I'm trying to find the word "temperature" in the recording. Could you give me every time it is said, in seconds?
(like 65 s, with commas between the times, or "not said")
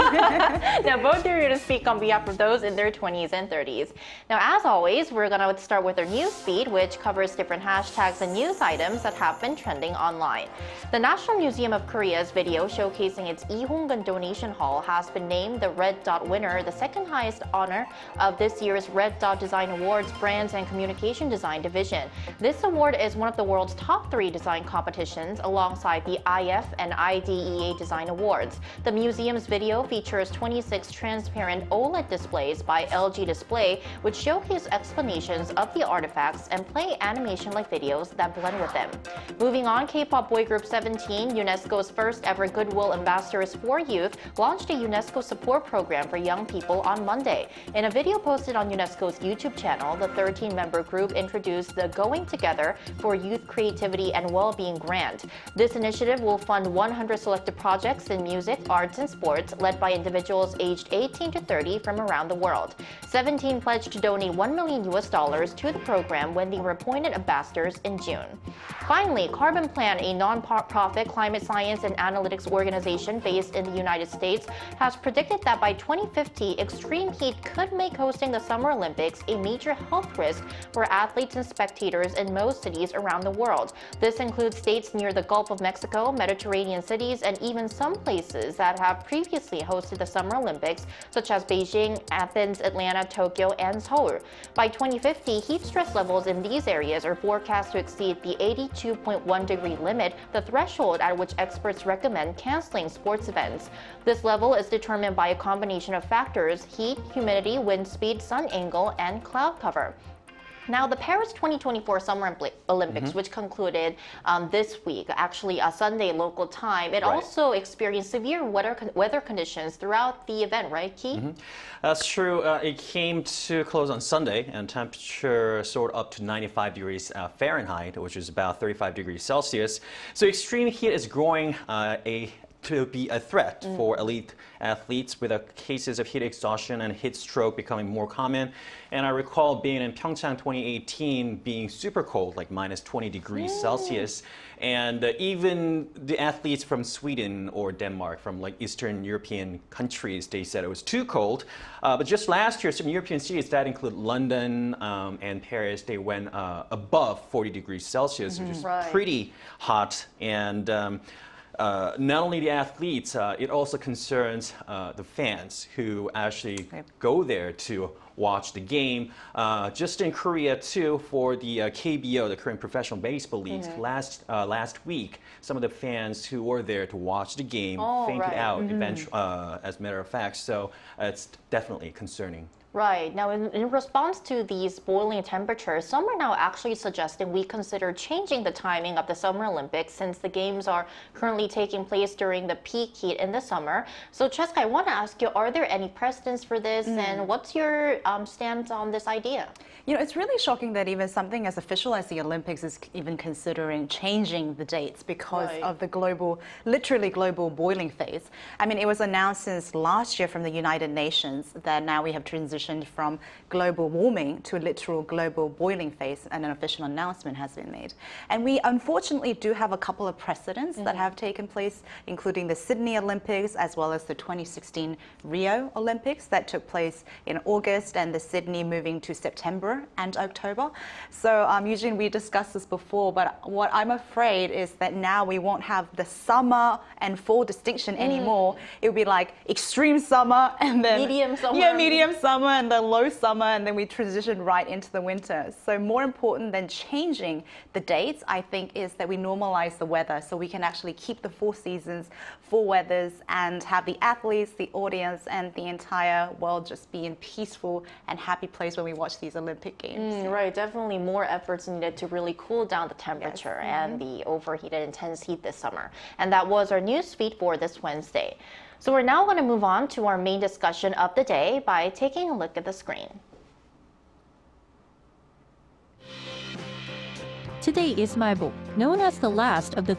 124 s, 185 s, 263 s.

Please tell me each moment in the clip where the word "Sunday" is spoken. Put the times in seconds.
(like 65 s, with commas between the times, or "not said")
115 s, 124 s.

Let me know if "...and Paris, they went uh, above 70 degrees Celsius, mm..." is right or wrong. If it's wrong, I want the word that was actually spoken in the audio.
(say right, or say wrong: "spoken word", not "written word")
wrong: "40", not "70".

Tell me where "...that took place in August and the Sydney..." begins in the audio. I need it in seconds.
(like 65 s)
226 s.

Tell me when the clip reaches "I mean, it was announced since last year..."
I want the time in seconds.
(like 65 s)
208 s.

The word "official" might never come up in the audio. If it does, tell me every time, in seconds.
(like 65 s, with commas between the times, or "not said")
201 s, 216 s.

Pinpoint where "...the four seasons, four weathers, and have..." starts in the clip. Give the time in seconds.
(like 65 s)
251 s.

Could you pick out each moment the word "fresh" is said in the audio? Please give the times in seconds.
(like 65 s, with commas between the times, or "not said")
not said.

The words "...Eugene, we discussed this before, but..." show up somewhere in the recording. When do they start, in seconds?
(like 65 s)
231 s.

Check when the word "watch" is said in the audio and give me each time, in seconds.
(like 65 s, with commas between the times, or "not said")
168 s, 176 s, 258 s.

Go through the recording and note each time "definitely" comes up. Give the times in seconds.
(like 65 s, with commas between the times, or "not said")
181 s, 260 s.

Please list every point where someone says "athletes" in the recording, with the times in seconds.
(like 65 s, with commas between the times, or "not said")
80 s, 134 s, 146 s, 162 s, 254 s.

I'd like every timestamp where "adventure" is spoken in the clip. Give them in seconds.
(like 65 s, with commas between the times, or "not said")
not said.